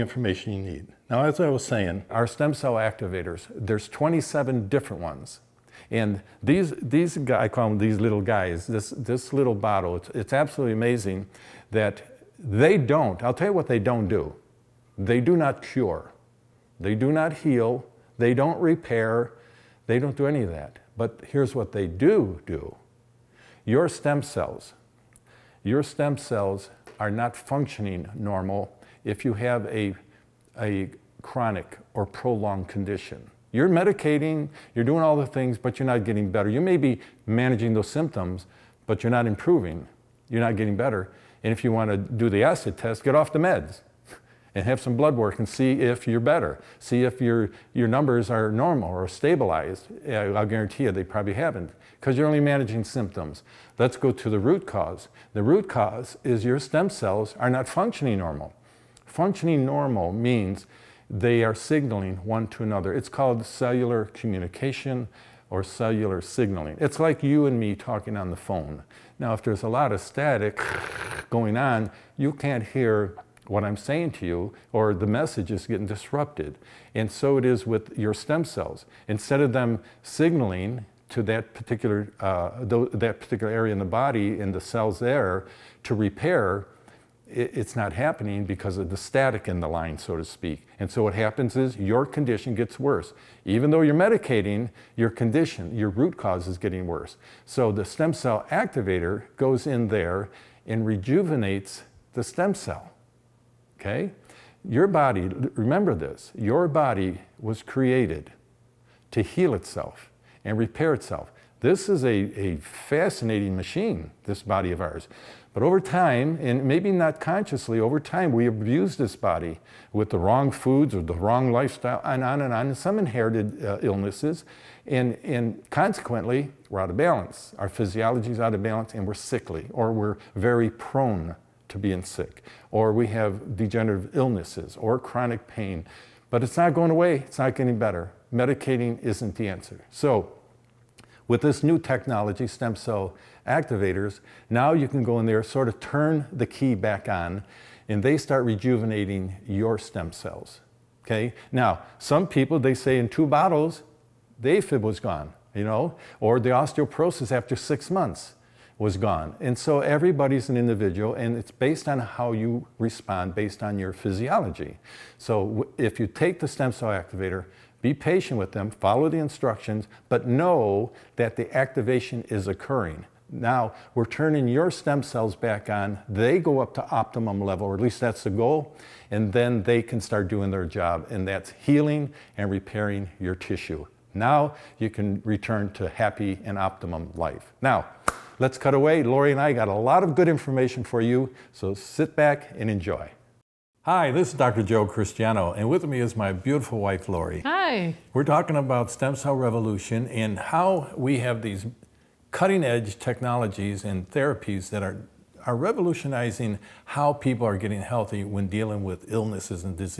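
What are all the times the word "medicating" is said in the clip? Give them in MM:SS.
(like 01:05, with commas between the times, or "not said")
00:33, 01:34, 02:18.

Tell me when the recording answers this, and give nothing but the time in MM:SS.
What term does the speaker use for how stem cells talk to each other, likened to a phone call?
01:03.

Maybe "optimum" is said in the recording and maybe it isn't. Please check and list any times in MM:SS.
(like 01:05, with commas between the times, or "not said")
02:56, 03:06.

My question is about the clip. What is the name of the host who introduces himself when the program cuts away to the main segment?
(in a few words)
Dr. Joe Christiano.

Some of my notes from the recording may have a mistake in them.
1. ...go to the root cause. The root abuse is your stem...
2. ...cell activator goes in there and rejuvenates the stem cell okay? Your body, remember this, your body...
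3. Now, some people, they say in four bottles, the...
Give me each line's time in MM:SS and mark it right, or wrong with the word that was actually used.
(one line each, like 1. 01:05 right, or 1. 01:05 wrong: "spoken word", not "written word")
1. 00:53 wrong: "cause", not "abuse"
2. 01:38 right
3. 02:31 wrong: "two", not "four".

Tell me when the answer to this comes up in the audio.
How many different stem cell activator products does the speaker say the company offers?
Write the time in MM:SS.
00:03.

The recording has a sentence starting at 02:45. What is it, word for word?
So if you take the stem cell activator, be patient with them, follow the instructions, but know that the activation is occurring.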